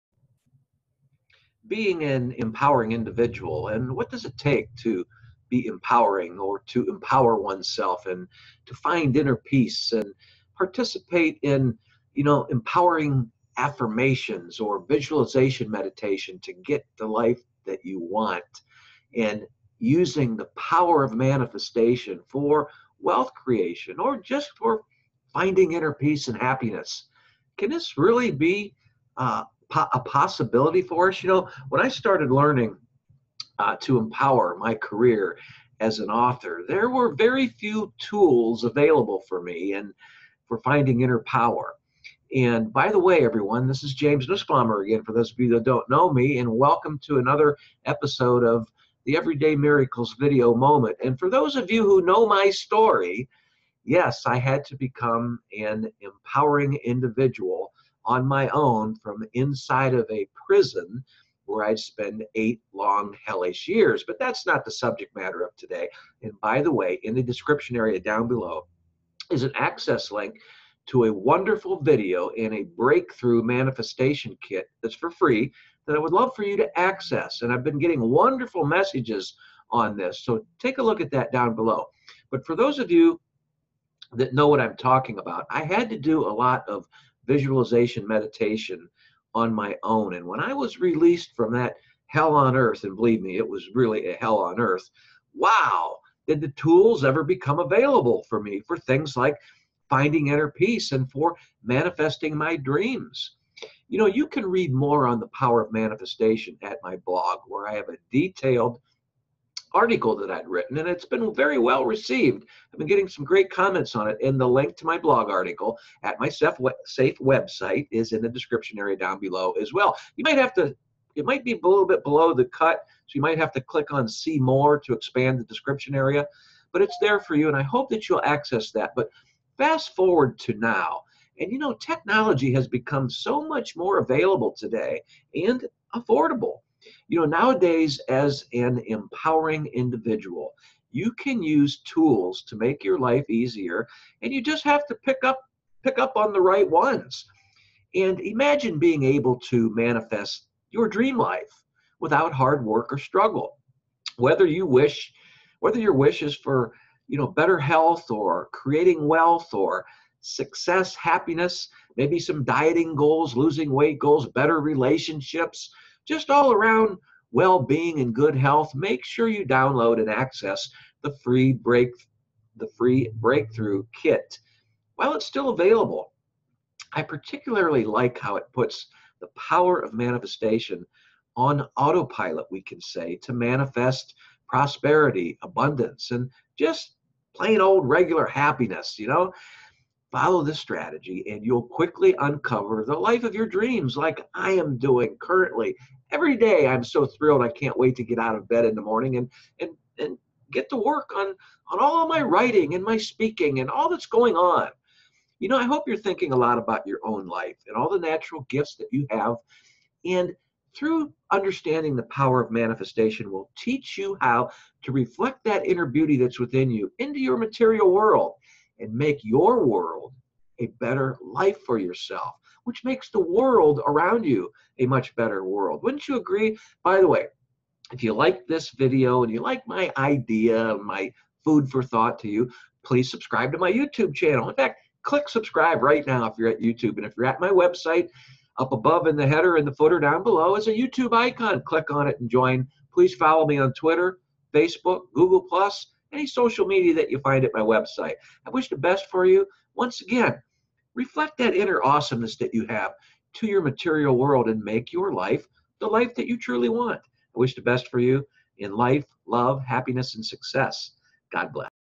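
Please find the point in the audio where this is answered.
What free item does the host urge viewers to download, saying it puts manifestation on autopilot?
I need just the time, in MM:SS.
02:53.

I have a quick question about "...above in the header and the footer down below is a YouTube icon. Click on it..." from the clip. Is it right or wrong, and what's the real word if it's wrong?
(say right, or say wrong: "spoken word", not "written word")
right.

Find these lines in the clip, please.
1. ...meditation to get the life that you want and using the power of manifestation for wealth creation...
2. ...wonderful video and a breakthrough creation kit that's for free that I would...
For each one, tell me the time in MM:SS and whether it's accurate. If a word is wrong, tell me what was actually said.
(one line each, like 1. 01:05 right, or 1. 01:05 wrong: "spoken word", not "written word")
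1. 00:15 right
2. 01:11 wrong: "manifestation", not "creation".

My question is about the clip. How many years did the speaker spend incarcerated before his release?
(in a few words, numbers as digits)
8.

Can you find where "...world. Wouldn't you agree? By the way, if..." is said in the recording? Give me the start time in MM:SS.
03:45.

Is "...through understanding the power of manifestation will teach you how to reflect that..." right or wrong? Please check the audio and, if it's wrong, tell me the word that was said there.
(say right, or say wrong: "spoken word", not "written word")
right.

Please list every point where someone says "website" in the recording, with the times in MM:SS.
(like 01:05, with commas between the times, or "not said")
01:57, 03:57, 04:07.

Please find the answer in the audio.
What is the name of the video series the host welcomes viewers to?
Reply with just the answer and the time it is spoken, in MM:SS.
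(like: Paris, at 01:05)
Everyday Miracles, at 00:49.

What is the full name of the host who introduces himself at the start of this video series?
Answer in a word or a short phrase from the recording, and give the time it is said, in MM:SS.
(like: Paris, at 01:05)
James Nussbaumer, at 00:43.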